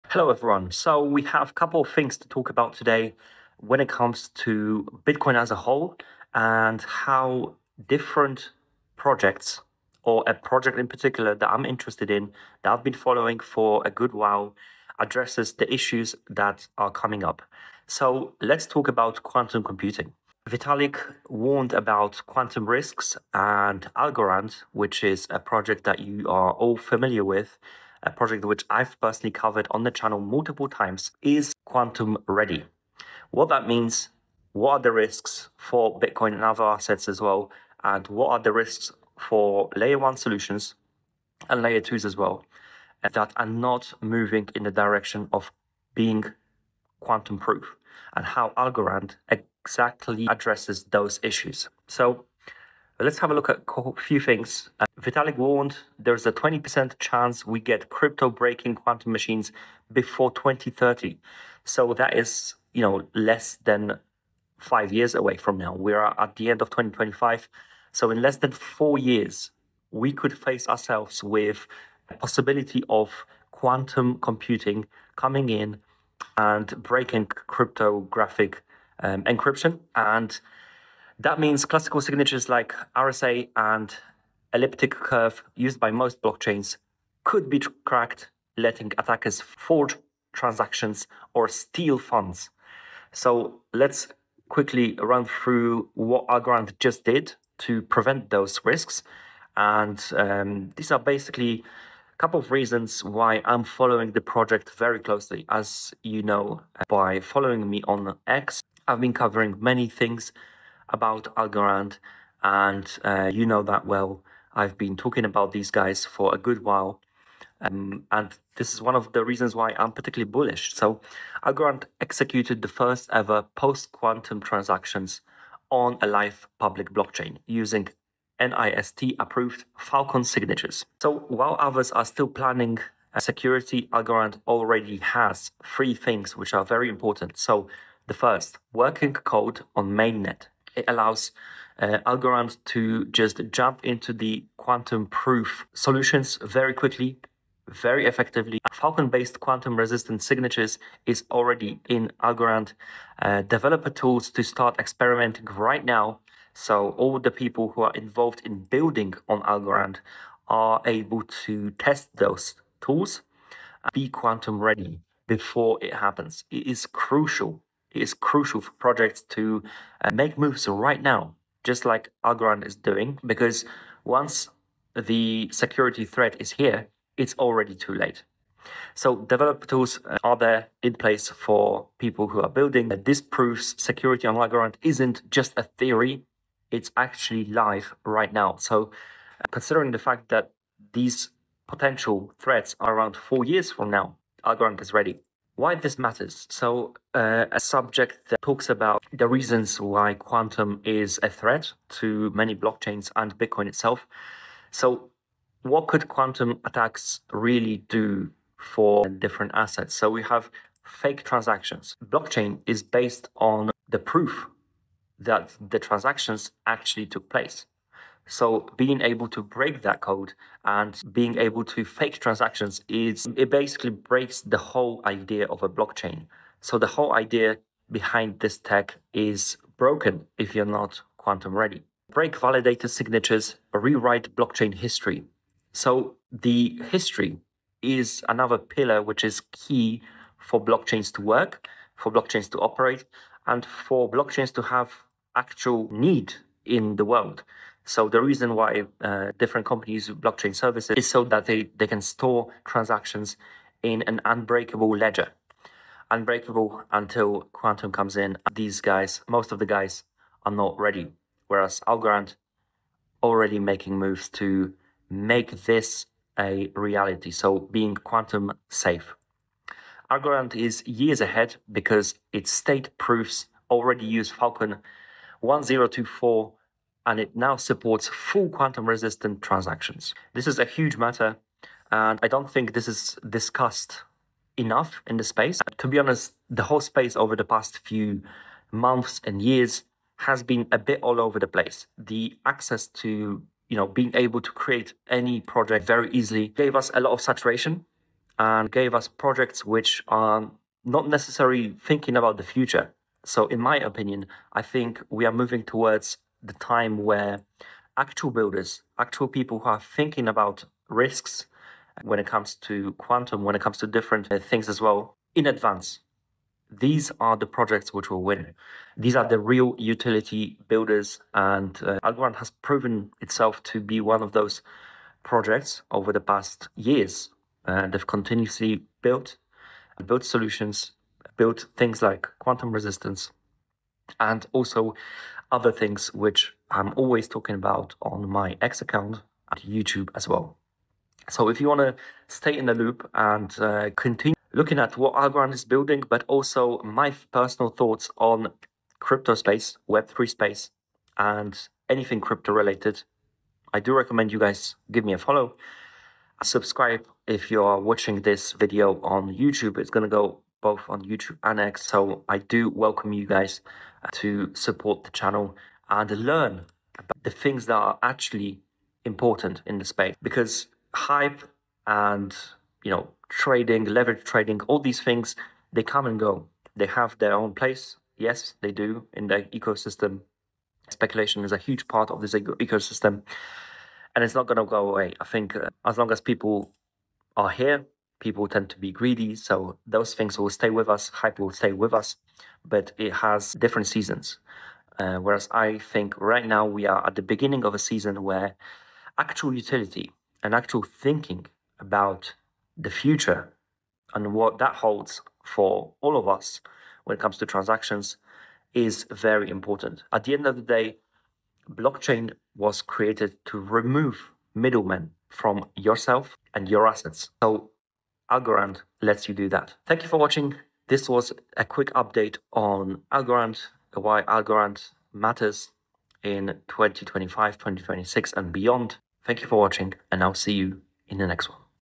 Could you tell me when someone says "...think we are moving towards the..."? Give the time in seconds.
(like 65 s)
304 s.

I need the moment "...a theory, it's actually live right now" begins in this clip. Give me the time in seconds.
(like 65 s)
185 s.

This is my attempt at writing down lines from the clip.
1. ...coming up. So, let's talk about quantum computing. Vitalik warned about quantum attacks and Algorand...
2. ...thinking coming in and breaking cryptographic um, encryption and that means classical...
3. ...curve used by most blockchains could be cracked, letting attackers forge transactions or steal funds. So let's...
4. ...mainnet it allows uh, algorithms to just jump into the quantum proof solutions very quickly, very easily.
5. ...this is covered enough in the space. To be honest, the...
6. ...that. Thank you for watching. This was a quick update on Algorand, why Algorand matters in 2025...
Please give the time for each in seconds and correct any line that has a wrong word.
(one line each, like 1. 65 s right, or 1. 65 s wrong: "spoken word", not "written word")
1. 16 s wrong: "risks", not "attacks"
2. 74 s wrong: "computing", not "thinking"
3. 84 s right
4. 139 s wrong: "effectively", not "easily"
5. 282 s wrong: "discussed", not "covered"
6. 419 s right.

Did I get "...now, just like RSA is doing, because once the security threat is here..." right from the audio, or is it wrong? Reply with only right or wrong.
wrong.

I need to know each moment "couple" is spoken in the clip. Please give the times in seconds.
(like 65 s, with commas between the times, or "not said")
1 s, 102 s.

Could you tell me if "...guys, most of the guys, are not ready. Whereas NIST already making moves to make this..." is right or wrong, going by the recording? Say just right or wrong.
wrong.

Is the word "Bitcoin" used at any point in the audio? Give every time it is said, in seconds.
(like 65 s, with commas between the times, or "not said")
5 s, 35 s, 203 s.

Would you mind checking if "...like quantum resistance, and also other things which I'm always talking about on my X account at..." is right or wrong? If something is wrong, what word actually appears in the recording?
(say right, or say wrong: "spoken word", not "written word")
right.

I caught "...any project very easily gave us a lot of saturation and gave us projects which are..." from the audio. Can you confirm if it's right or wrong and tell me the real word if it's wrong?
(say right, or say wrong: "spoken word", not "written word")
right.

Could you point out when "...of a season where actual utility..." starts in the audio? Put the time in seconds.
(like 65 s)
397 s.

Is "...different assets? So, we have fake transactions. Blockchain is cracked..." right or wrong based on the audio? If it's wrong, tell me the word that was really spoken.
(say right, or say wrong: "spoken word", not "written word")
wrong: "based", not "cracked".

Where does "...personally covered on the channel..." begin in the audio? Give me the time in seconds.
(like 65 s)
28 s.